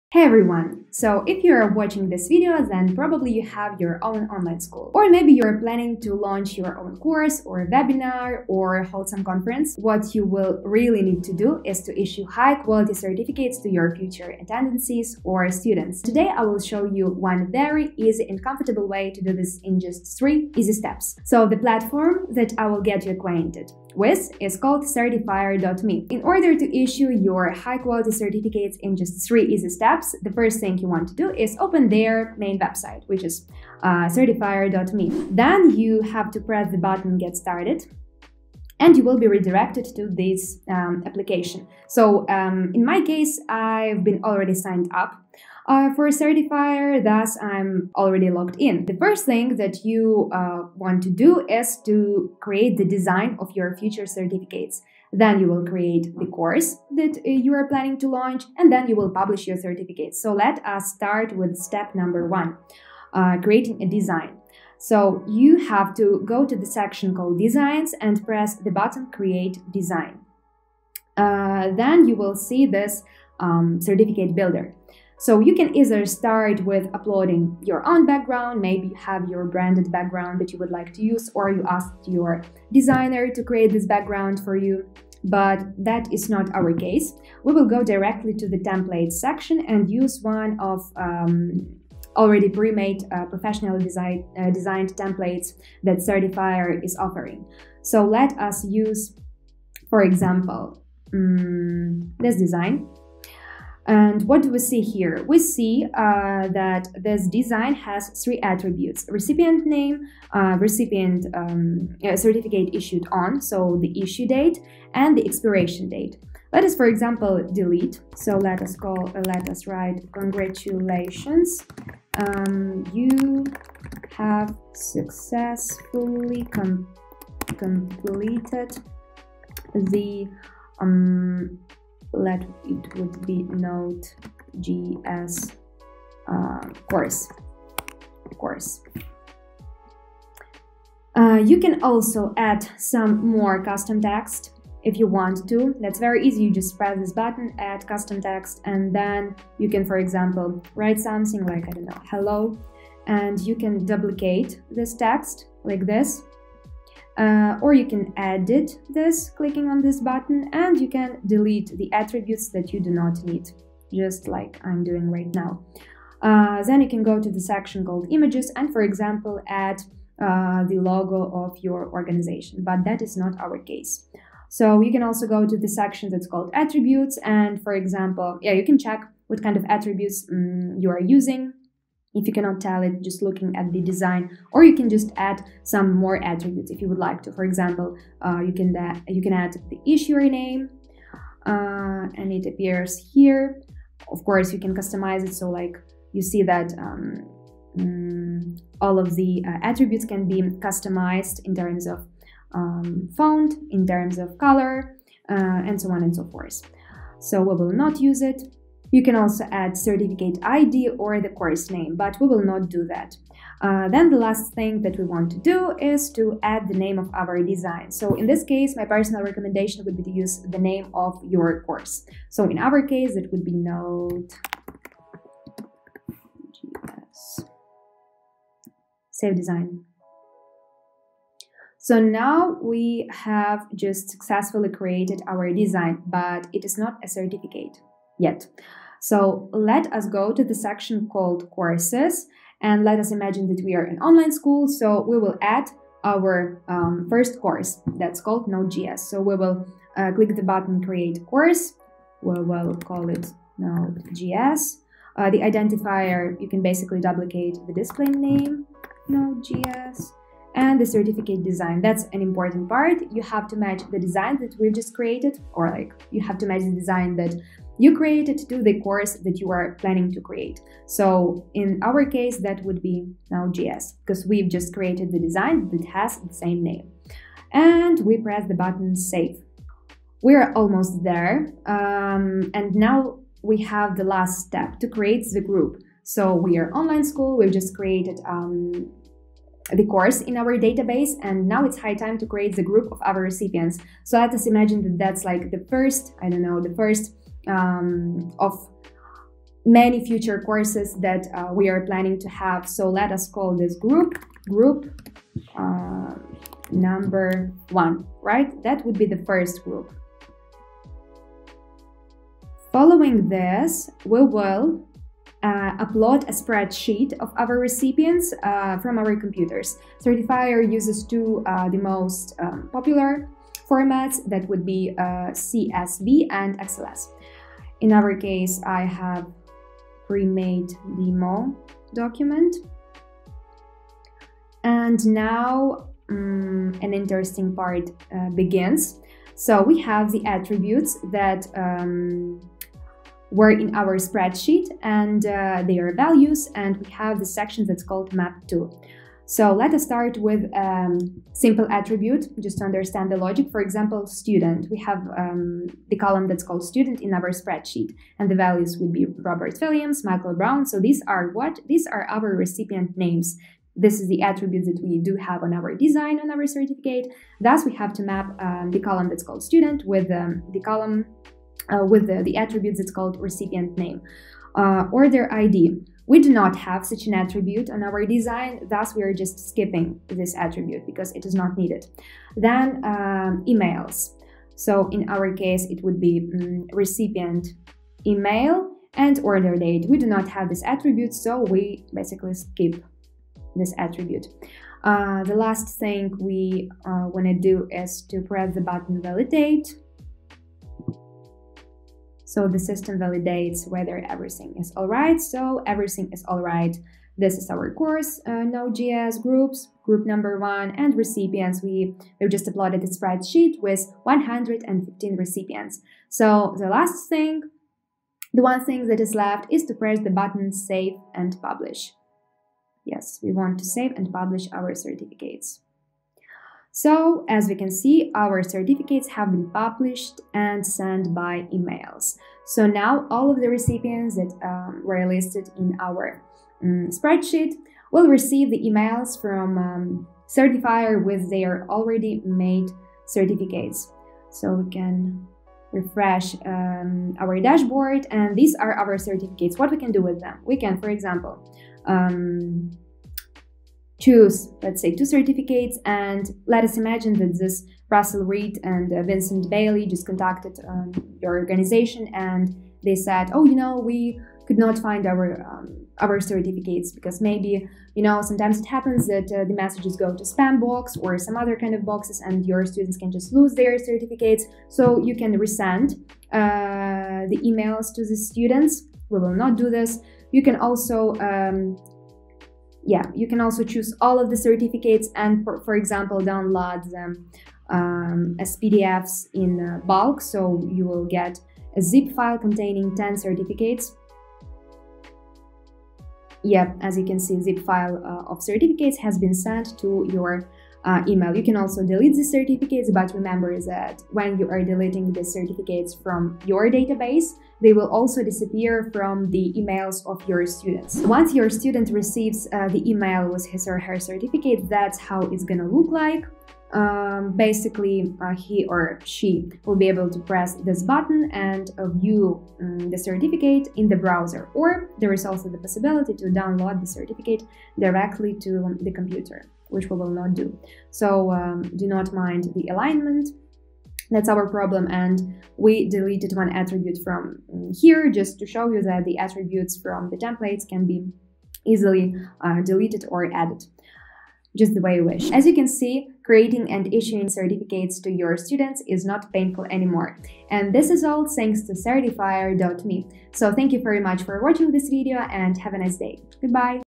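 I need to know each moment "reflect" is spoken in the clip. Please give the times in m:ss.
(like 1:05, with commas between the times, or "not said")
not said.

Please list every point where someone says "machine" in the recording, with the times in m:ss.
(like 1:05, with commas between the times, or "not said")
not said.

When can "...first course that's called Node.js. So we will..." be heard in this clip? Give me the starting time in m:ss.
4:07.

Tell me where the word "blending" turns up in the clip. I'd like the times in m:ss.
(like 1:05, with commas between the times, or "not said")
not said.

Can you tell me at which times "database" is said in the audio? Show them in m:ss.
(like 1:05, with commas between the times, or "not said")
4:50, 8:26.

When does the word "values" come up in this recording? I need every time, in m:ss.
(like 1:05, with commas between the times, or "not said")
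5:45, 5:58.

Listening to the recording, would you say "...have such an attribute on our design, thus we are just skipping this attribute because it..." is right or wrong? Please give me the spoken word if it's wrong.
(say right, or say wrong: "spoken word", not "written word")
right.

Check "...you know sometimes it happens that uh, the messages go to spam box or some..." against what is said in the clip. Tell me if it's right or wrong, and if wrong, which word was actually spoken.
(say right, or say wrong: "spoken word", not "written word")
right.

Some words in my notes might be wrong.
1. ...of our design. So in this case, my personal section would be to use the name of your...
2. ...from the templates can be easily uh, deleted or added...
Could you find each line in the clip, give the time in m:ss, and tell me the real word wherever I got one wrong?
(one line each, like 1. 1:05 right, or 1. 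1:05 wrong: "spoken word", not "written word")
1. 3:36 wrong: "recommendation", not "section"
2. 8:59 right.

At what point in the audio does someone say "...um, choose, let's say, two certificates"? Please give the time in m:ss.
7:31.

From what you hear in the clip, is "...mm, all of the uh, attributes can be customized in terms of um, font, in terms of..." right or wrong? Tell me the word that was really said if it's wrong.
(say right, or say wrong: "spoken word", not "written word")
right.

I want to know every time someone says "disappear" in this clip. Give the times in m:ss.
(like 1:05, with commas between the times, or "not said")
8:28.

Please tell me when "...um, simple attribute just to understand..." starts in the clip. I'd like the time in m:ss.
5:50.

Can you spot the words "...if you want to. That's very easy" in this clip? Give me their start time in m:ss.
2:24.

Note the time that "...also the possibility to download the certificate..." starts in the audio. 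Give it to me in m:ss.
8:45.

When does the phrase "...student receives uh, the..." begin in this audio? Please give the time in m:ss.
8:31.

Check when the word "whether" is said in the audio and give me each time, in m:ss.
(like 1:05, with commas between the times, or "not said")
6:43.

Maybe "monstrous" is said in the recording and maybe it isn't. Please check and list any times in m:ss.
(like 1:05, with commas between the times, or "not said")
not said.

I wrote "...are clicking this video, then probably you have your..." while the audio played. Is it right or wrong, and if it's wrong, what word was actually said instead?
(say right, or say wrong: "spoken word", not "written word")
wrong: "watching", not "clicking".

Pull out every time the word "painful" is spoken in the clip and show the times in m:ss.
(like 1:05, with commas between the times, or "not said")
9:09.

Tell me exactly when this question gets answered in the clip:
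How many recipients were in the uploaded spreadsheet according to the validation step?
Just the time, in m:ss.
6:54.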